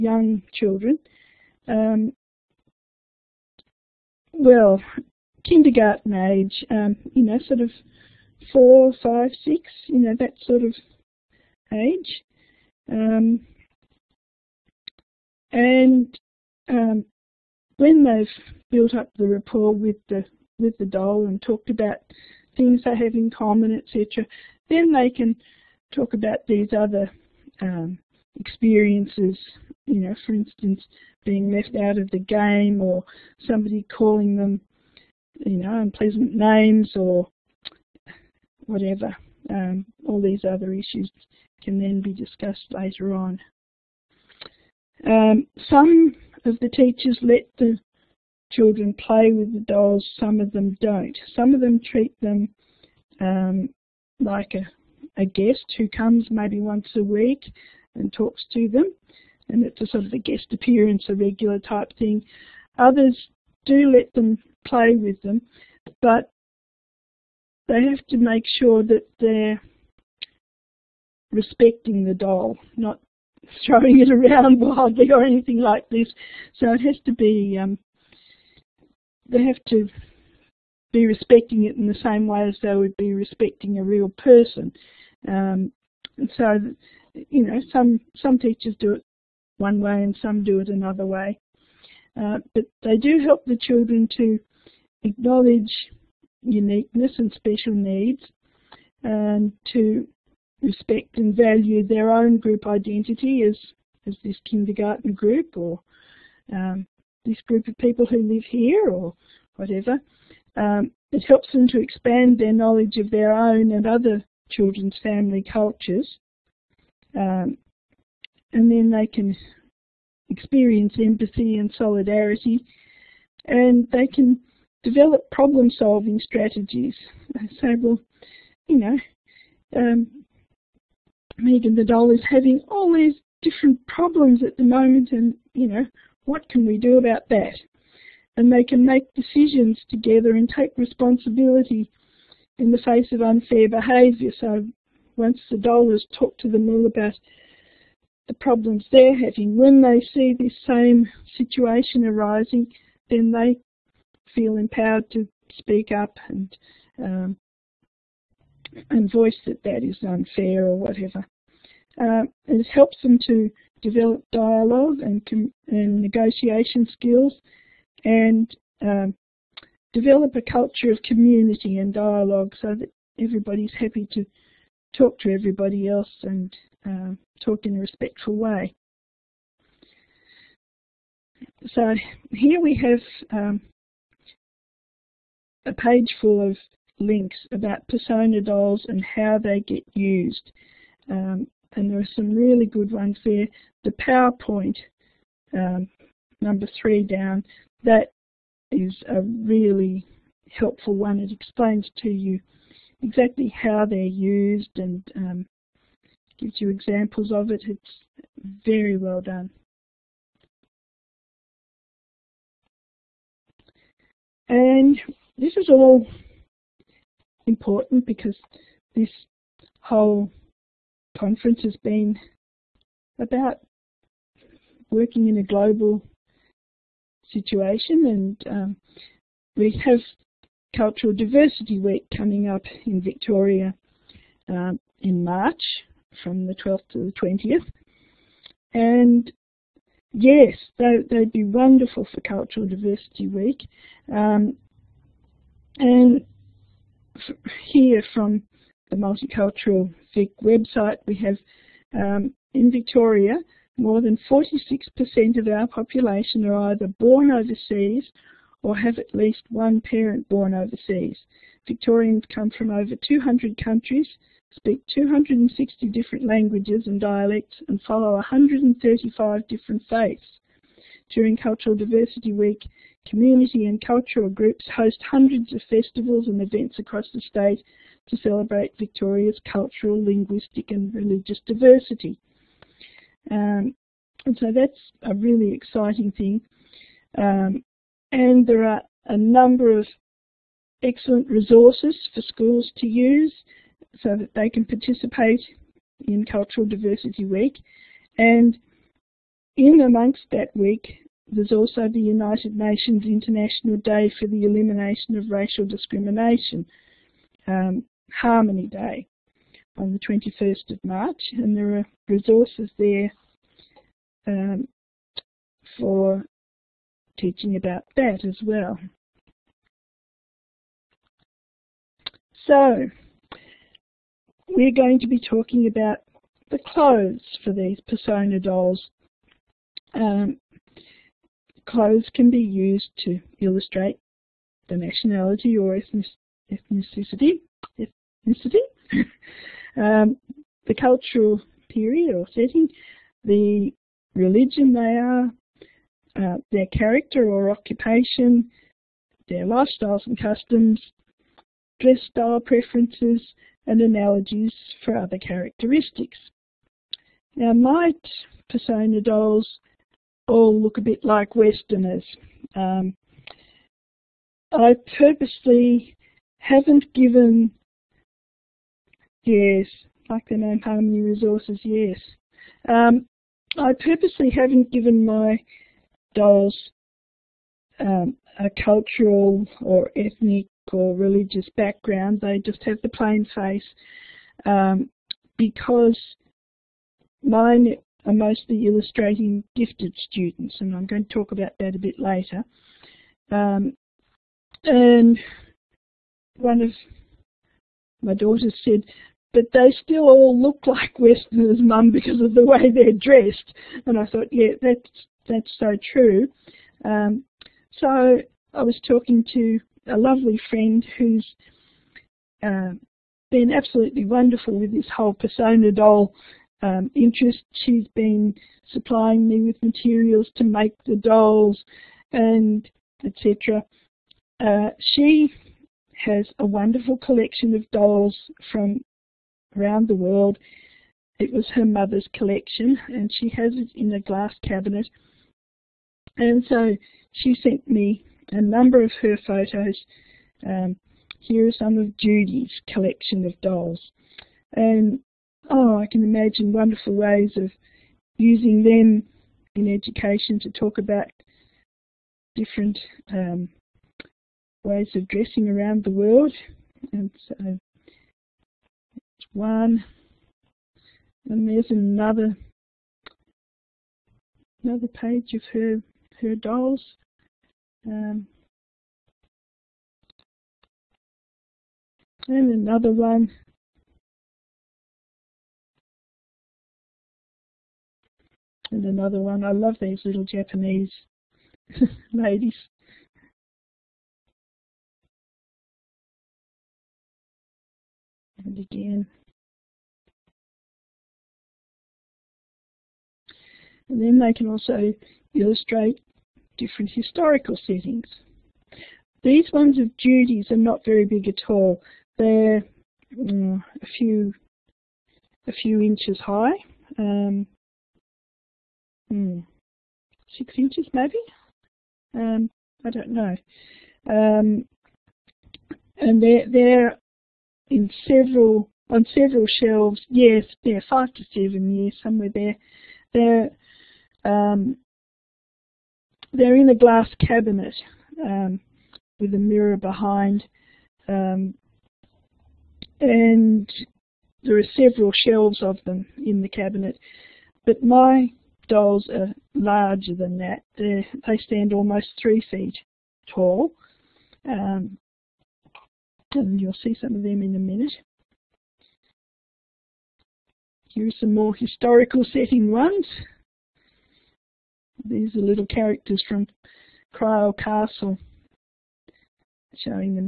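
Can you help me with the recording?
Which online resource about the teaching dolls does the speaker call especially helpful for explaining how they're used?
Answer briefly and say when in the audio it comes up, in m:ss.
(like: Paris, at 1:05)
The PowerPoint, at 3:13.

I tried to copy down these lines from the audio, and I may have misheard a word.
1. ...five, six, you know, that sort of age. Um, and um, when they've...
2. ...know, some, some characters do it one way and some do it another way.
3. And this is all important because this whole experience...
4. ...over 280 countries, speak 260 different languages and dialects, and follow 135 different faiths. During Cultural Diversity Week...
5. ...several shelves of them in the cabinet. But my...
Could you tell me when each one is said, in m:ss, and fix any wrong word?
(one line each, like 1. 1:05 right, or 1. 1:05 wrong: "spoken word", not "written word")
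1. 0:09 right
2. 1:27 wrong: "teachers", not "characters"
3. 3:34 wrong: "conference", not "experience"
4. 4:22 wrong: "200", not "280"
5. 8:54 right.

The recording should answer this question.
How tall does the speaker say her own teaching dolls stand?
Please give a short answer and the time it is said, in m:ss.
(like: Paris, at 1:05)
Almost three feet, at 9:01.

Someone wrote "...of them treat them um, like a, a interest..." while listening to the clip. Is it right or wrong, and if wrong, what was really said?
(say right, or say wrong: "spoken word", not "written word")
wrong: "guest", not "interest".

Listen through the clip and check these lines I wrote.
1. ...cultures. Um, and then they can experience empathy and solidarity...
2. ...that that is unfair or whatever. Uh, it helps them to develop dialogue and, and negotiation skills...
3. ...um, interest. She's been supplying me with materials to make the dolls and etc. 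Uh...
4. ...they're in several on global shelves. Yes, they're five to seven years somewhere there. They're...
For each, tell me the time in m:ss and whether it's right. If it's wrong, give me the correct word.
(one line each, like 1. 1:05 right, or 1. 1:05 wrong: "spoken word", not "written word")
1. 1:55 right
2. 2:39 right
3. 6:56 right
4. 8:36 wrong: "several", not "global".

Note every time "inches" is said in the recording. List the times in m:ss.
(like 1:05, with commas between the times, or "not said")
8:25, 8:30.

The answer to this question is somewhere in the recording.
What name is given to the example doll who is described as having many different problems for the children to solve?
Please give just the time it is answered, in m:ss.
2:11.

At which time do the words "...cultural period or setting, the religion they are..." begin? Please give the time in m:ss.
5:40.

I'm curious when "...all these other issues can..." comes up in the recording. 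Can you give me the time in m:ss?
0:40.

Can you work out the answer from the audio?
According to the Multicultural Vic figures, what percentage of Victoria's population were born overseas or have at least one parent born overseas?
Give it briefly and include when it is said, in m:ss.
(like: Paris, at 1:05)
More than 46%, at 4:13.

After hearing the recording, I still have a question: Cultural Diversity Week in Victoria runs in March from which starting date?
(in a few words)
12th.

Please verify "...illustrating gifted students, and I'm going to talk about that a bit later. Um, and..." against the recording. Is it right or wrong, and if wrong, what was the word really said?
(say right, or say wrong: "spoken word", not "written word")
right.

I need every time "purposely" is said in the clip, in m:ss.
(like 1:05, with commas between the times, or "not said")
6:04, 6:13.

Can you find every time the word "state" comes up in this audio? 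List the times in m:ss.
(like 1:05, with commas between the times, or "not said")
4:37.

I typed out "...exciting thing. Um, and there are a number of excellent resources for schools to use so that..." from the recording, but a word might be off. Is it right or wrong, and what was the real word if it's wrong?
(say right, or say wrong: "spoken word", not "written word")
right.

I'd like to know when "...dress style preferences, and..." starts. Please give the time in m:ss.
5:51.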